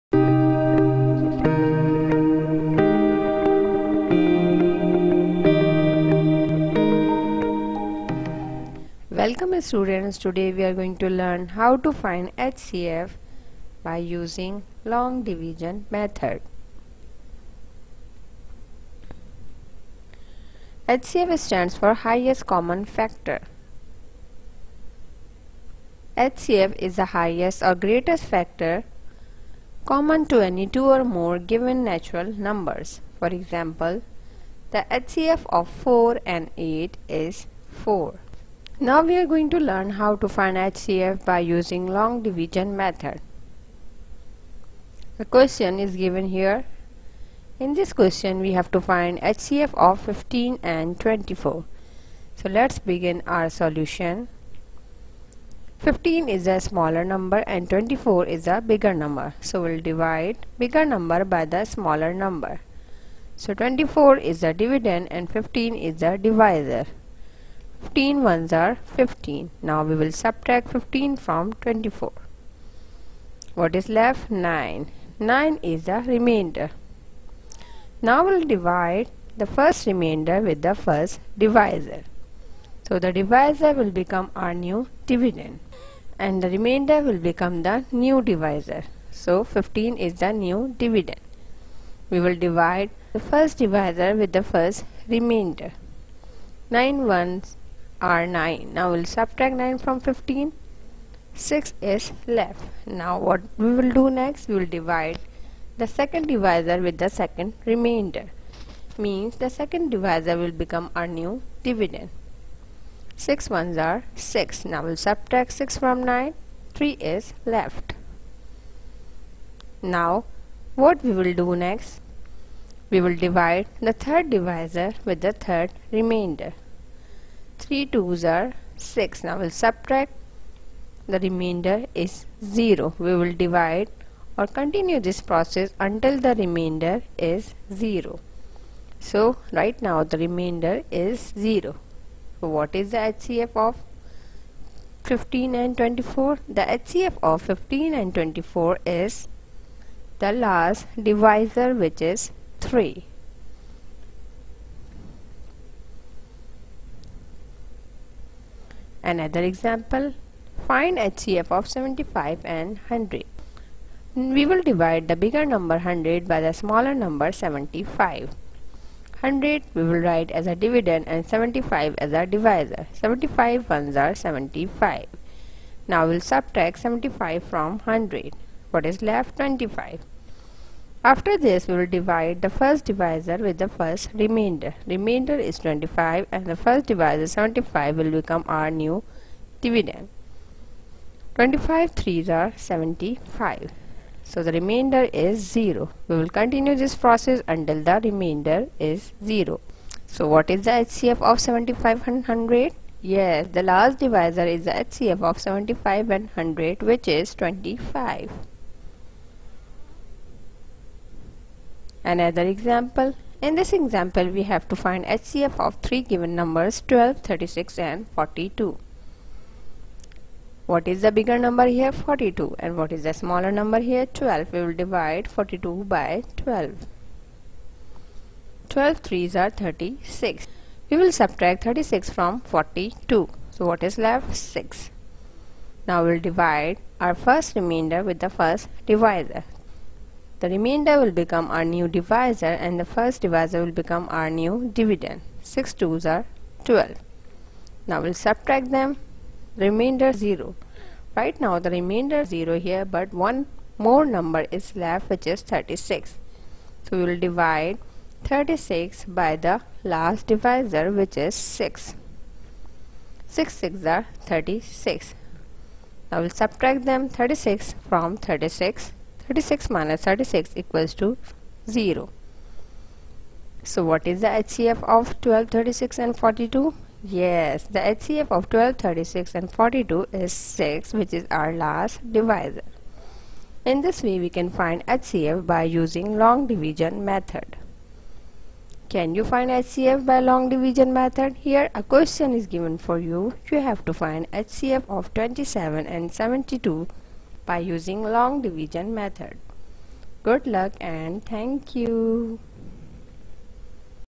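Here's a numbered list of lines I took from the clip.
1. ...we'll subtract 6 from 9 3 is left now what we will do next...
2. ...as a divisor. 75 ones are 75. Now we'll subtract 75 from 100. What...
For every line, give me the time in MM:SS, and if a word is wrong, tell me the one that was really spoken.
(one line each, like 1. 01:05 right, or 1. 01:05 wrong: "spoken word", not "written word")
1. 01:54 right
2. 02:51 right.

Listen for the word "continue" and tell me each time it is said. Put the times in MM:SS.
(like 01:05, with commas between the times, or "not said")
02:14, 03:16.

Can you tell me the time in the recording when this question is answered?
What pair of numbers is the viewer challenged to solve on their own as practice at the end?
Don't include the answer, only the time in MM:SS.
04:55.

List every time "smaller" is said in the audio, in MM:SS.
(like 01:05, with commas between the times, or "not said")
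00:56, 01:01, 02:46, 03:43.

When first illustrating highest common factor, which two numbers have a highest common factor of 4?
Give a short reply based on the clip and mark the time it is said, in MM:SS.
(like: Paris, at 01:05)
4 and 8, at 00:35.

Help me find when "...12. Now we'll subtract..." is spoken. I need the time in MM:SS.
04:06.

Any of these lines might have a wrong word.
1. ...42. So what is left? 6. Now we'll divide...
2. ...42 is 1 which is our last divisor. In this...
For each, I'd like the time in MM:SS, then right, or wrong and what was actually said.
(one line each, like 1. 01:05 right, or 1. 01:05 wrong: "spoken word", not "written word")
1. 03:52 right
2. 04:39 wrong: "6", not "1".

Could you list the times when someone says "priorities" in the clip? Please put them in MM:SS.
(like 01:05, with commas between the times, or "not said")
not said.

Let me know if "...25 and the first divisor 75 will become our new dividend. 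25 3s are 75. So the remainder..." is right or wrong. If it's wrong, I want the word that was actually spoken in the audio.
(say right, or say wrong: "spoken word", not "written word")
right.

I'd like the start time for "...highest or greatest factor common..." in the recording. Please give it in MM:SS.
00:27.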